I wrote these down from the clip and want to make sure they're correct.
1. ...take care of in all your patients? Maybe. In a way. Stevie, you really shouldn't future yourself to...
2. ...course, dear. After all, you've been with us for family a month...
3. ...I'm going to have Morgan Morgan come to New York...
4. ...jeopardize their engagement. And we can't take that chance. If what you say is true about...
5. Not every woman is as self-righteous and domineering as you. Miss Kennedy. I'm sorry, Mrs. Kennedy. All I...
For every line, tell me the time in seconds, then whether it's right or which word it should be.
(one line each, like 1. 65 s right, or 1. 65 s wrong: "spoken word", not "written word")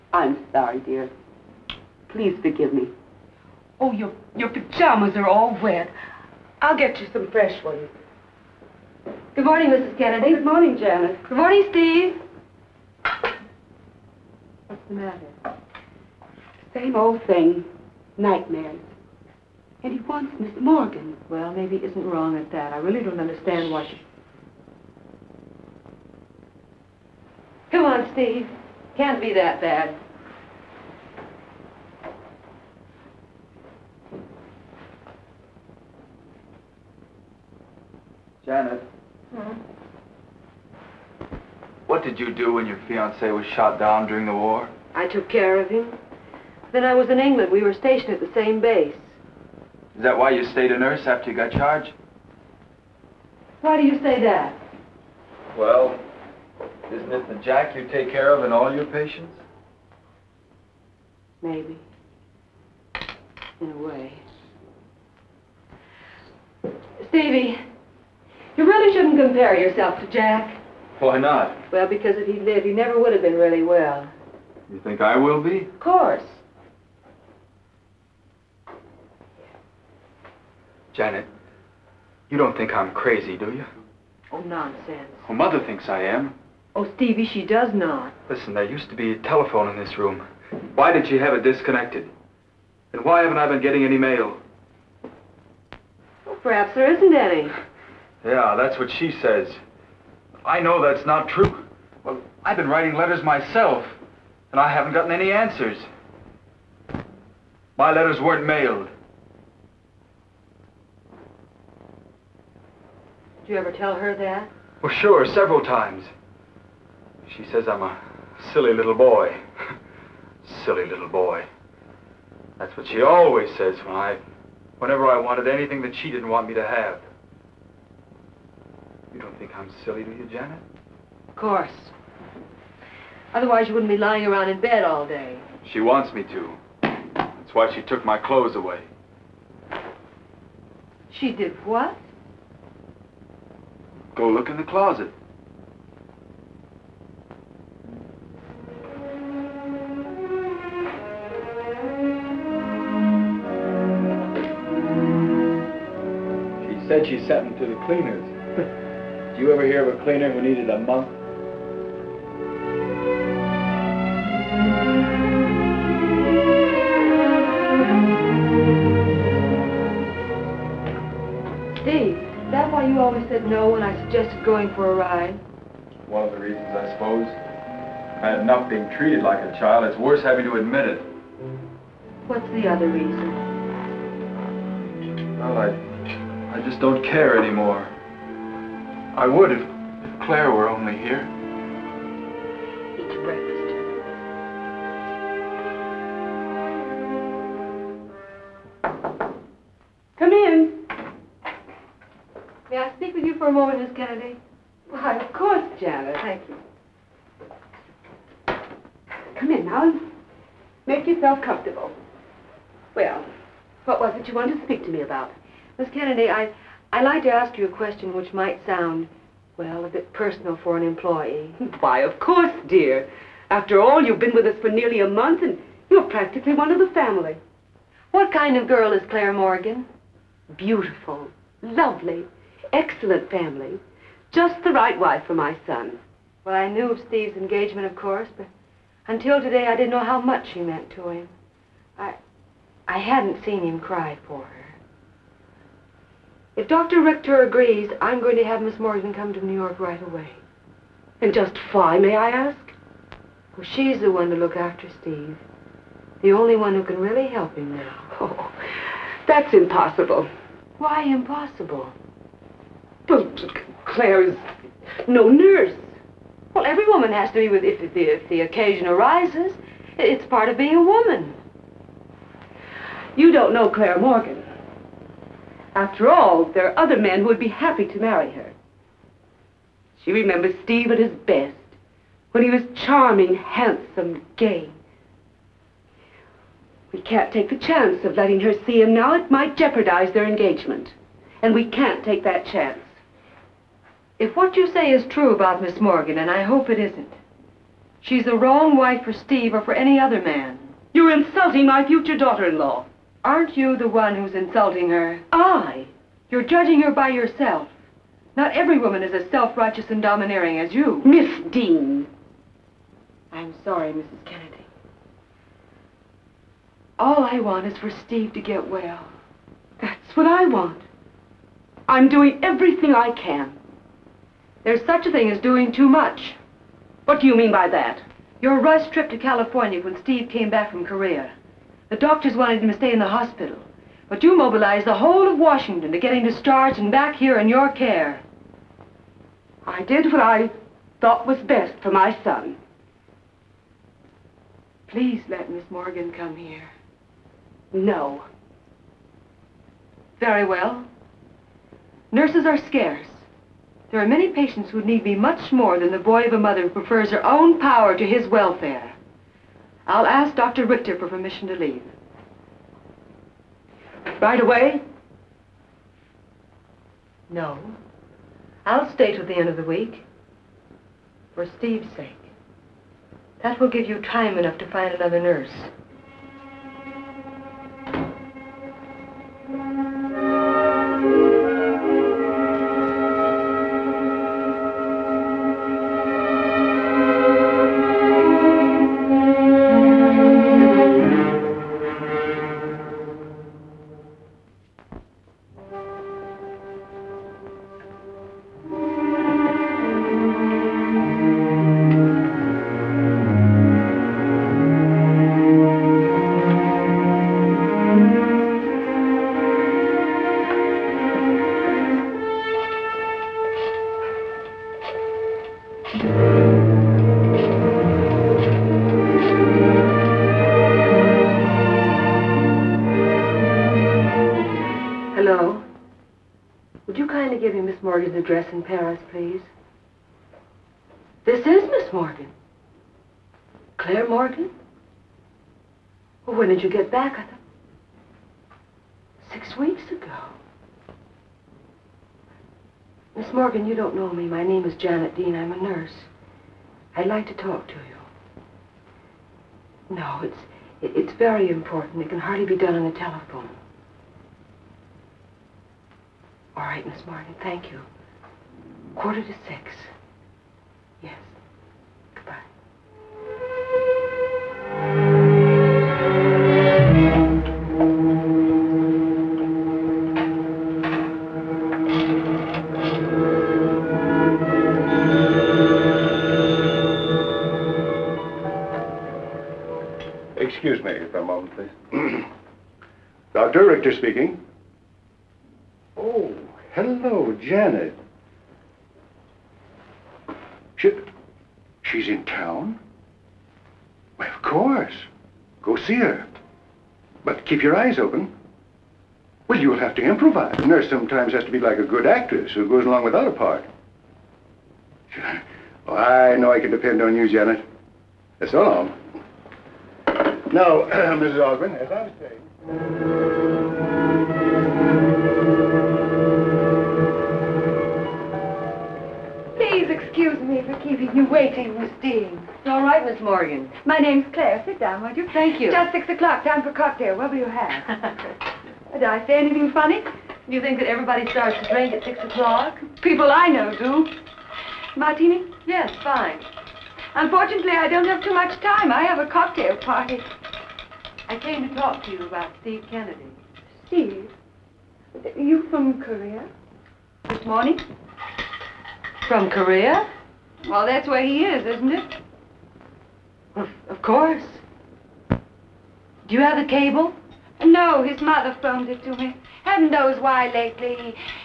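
1. 57 s wrong: "compare", not "future"
2. 222 s wrong: "nearly", not "family"
3. 248 s wrong: "Miss", not "Morgan"
4. 289 s right
5. 308 s wrong: "Dean", not "Kennedy".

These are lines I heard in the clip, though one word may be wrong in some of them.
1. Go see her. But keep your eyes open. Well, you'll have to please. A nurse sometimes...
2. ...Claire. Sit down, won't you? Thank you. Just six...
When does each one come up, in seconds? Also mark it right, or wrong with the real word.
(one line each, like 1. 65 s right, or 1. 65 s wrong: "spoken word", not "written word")
1. 495 s wrong: "improvise", not "please"
2. 524 s right.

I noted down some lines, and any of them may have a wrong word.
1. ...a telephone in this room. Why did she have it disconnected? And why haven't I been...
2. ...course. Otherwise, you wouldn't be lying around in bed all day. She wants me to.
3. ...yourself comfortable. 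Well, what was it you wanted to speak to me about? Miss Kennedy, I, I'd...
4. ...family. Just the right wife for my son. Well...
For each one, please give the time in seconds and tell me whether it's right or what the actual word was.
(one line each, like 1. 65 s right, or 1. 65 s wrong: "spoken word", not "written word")
1. 89 s right
2. 131 s right
3. 211 s right
4. 233 s right.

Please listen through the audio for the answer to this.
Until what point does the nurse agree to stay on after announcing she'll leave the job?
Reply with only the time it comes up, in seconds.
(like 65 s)
369 s.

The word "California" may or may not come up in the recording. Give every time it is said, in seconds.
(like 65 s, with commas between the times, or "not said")
329 s.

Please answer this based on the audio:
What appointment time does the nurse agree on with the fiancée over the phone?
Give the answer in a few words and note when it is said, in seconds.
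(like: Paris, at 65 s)
Quarter to six, at 458 s.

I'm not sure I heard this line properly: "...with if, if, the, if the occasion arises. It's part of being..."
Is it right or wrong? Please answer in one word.
right.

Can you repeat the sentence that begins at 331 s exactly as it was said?
The doctors wanted him to stay in the hospital.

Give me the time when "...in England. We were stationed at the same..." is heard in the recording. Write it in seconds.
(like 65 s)
47 s.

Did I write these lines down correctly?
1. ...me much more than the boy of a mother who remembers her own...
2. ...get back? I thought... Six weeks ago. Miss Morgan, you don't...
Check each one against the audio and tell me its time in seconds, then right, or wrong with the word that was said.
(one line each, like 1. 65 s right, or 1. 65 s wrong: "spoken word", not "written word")
1. 355 s wrong: "prefers", not "remembers"
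2. 436 s right.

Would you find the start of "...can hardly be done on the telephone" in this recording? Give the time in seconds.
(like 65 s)
452 s.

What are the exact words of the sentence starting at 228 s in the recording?
What kind of girl is Claire Morgan?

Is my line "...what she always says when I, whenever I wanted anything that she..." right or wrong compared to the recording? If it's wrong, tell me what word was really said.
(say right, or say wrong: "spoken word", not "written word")
right.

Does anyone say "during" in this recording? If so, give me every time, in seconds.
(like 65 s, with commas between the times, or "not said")
44 s.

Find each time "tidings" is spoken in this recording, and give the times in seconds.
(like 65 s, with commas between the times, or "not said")
not said.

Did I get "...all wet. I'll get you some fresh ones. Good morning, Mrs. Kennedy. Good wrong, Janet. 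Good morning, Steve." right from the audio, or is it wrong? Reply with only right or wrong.
wrong.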